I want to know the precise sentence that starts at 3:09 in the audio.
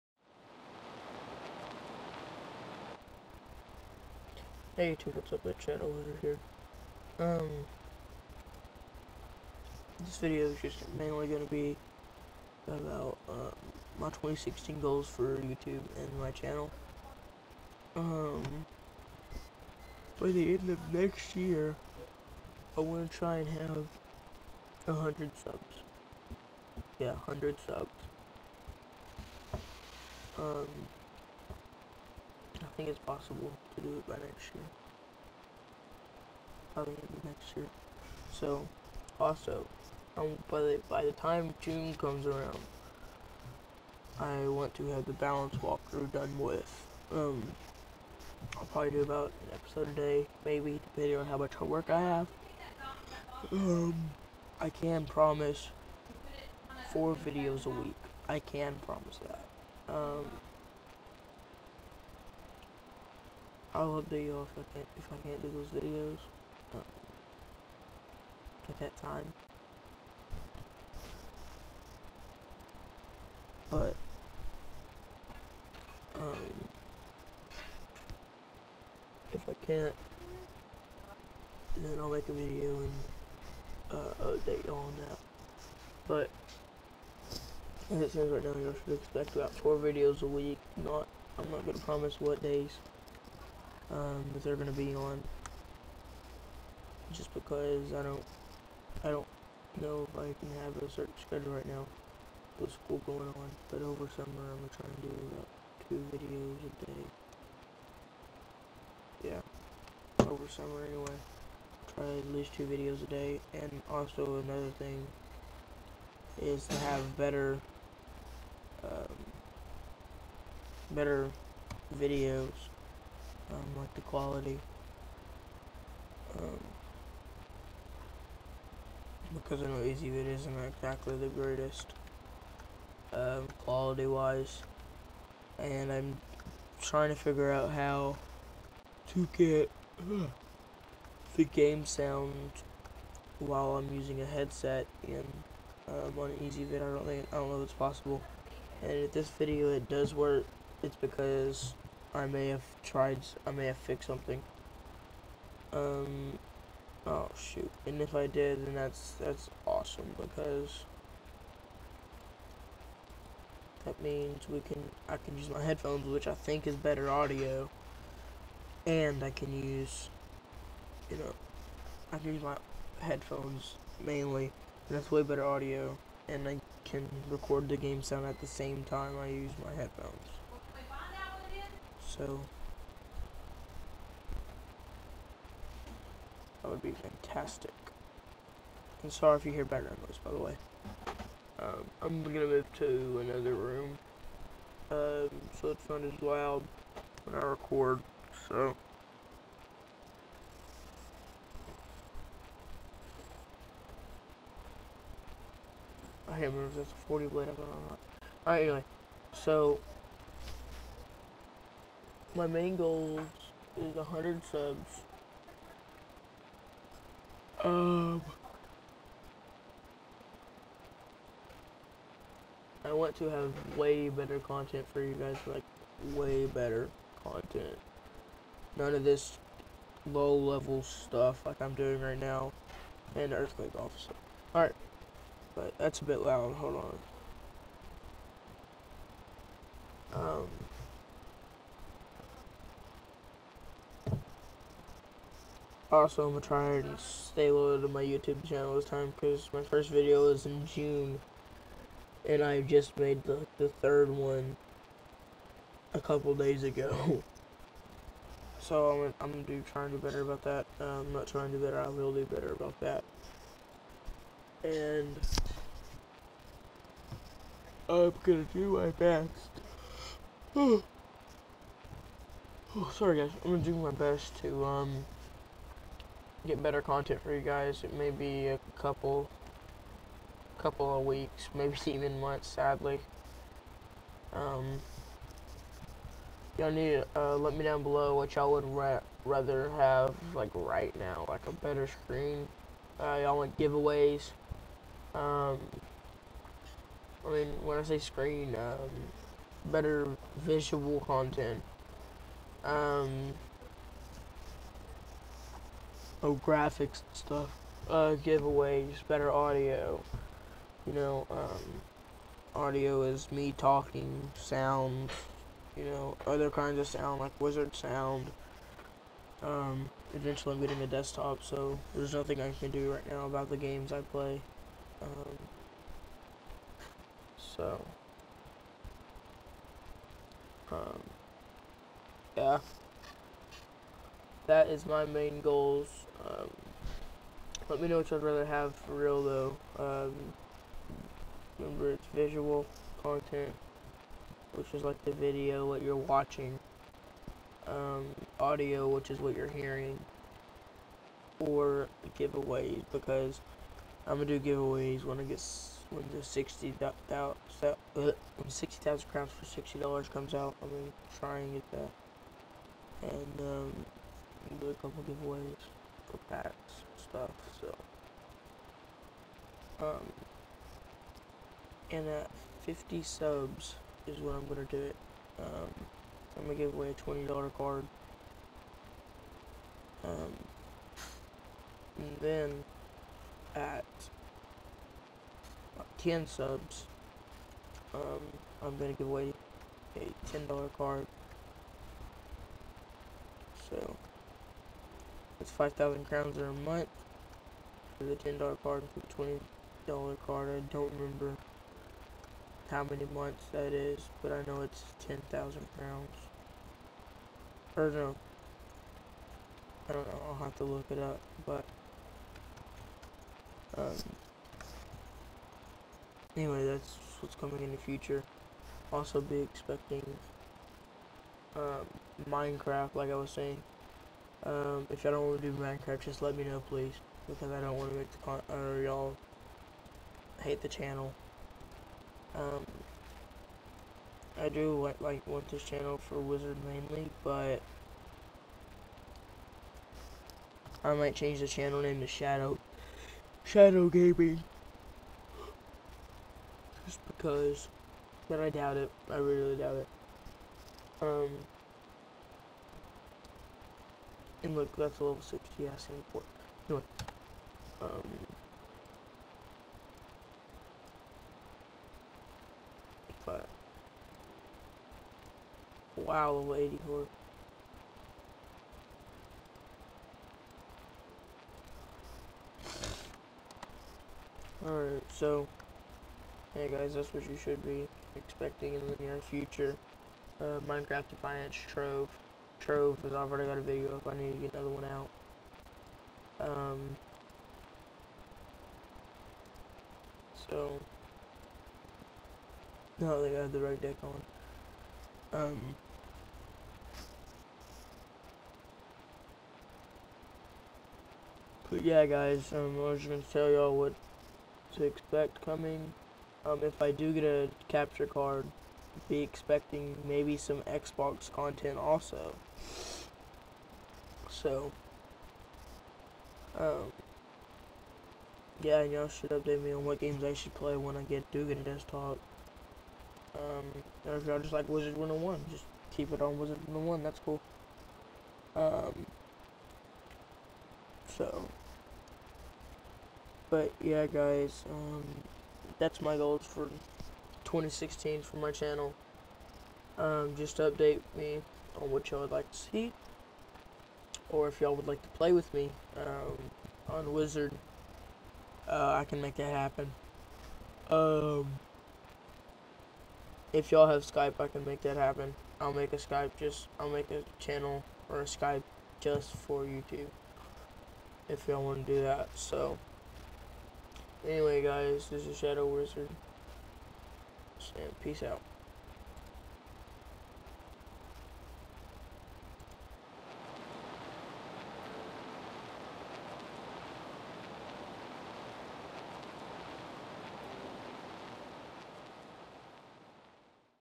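And sorry if you hear background noise, by the way.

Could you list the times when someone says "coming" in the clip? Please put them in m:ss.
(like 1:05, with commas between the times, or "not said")
6:57, 8:25.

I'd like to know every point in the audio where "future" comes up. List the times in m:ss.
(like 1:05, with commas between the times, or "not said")
6:57, 7:59.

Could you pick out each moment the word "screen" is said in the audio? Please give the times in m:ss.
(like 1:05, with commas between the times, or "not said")
4:51, 4:57.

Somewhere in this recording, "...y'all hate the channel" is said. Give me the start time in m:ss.
7:08.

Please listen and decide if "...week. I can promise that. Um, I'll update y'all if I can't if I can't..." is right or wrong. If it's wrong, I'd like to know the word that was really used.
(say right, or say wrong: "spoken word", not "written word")
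right.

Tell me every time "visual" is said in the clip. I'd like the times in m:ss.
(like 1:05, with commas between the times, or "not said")
5:00, 5:42.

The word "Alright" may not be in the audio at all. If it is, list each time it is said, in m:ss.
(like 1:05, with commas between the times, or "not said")
3:28, 3:54, 7:54.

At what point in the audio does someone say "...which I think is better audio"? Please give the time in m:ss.
2:46.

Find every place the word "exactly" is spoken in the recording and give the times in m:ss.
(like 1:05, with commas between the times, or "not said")
2:10.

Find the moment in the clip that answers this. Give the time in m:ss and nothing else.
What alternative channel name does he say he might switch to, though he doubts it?
7:23.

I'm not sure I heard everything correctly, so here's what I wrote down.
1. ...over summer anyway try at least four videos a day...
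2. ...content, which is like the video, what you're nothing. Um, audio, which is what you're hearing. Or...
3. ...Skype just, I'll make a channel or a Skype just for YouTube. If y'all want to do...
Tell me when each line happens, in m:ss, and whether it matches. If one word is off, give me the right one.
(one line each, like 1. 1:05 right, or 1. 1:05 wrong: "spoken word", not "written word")
1. 1:50 wrong: "two", not "four"
2. 5:43 wrong: "watching", not "nothing"
3. 9:15 right.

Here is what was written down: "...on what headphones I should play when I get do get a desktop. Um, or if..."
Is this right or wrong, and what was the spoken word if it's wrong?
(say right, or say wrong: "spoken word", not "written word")
wrong: "games", not "headphones".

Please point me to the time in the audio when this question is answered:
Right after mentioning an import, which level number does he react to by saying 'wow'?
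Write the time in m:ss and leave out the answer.
7:46.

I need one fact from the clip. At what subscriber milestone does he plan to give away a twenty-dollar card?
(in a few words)
50.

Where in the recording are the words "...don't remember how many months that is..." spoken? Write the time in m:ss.
6:40.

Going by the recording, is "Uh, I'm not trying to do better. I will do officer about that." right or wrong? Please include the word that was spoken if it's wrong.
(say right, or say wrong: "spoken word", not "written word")
wrong: "better", not "officer".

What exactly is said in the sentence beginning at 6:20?
Um, and then at 10 subs, um, I'm gonna give away a $10 card.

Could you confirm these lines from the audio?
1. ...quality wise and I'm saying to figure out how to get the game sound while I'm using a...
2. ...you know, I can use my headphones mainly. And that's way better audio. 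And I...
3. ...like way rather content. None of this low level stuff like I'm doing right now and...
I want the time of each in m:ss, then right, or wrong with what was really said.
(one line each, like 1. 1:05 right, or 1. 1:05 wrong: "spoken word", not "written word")
1. 2:13 wrong: "trying", not "saying"
2. 2:51 right
3. 3:45 wrong: "better", not "rather".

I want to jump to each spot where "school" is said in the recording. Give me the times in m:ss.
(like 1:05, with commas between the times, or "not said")
1:42.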